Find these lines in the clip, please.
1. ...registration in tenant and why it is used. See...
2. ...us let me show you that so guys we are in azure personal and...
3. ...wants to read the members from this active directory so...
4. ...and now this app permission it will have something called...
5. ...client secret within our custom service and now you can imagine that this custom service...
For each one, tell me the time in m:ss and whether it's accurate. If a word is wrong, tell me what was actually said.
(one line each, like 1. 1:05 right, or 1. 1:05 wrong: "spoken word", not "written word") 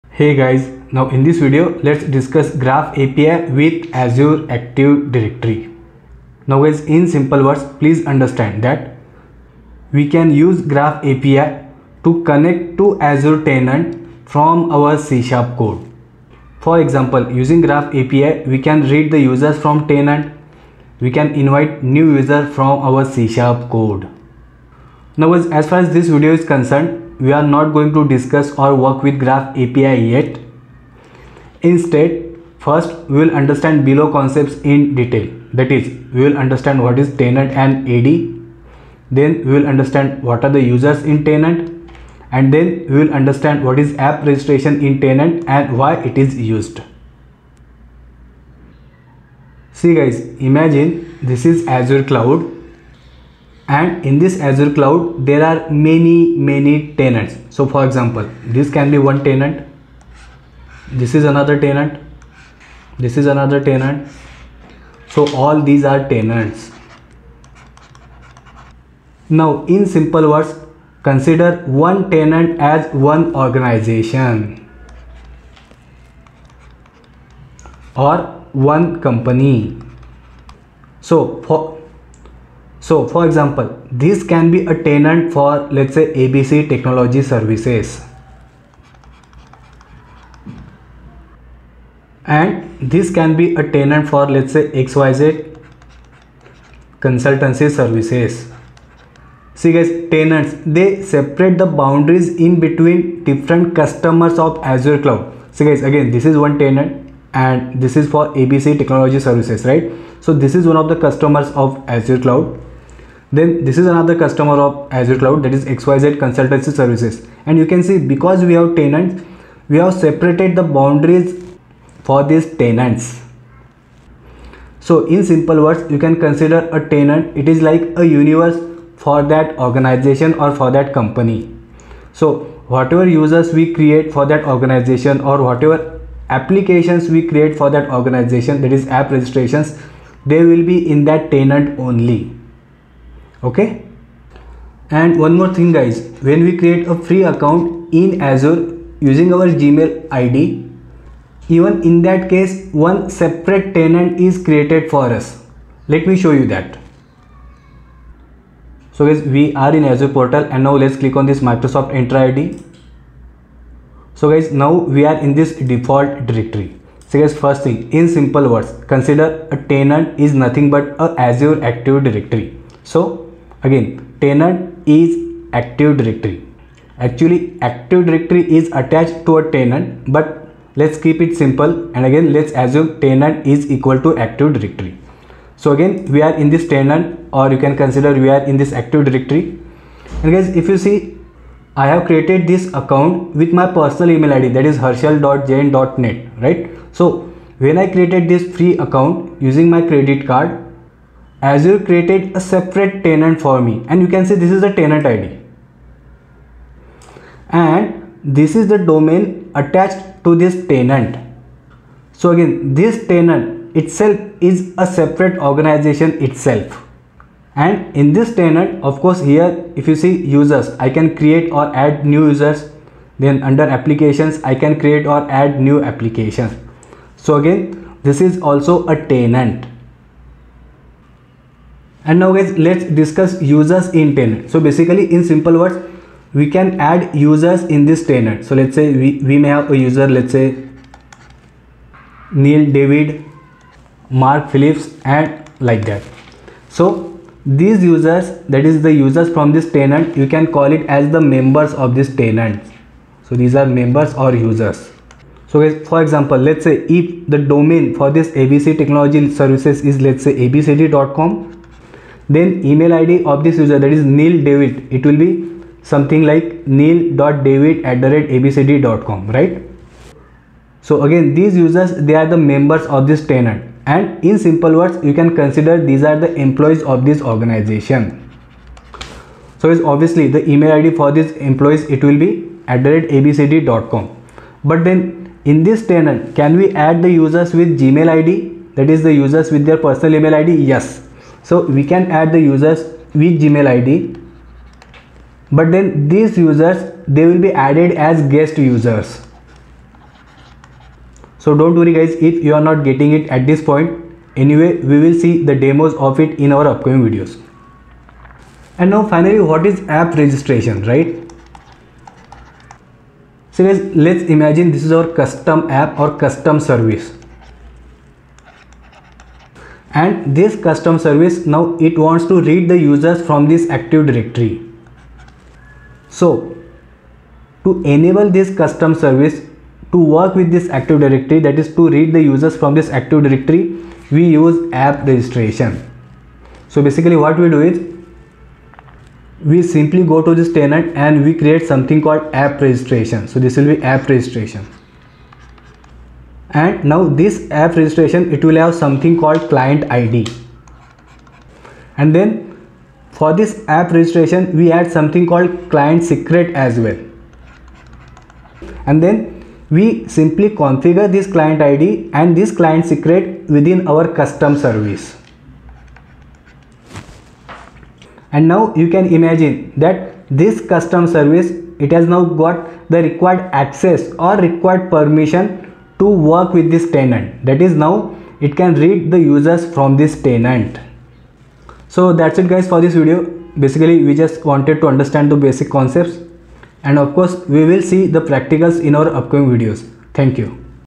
1. 0:44 right
2. 2:35 wrong: "portal", not "personal"
3. 5:21 wrong: "users", not "members"
4. 5:46 wrong: "registration", not "permission"
5. 6:02 right.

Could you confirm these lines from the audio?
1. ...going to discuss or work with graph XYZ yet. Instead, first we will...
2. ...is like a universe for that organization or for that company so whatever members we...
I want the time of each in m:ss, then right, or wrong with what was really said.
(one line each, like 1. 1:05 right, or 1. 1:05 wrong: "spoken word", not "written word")
1. 0:27 wrong: "API", not "XYZ"
2. 2:07 wrong: "users", not "members".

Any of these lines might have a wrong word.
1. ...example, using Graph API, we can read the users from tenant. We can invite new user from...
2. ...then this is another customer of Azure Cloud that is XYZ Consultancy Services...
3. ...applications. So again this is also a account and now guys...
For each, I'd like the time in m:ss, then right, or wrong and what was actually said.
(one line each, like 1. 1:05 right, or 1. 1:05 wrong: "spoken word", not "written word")
1. 0:16 right
2. 1:53 right
3. 3:45 wrong: "tenant", not "account".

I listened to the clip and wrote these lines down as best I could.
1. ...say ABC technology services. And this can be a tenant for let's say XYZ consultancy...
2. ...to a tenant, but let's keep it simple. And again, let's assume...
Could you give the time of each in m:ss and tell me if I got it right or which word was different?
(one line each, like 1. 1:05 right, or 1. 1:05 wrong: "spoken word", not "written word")
1. 1:25 right
2. 2:59 right.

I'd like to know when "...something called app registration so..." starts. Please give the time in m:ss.
5:41.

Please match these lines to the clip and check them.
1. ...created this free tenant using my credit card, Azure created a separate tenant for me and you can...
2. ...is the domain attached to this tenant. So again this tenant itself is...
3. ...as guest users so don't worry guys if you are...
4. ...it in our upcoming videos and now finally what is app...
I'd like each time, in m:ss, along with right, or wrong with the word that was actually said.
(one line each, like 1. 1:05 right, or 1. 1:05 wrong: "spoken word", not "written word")
1. 3:17 wrong: "account", not "tenant"
2. 3:28 right
3. 4:58 right
4. 5:06 right.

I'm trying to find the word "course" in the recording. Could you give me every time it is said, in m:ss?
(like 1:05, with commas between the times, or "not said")
3:38, 6:27.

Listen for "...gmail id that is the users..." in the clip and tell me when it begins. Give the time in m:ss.
4:47.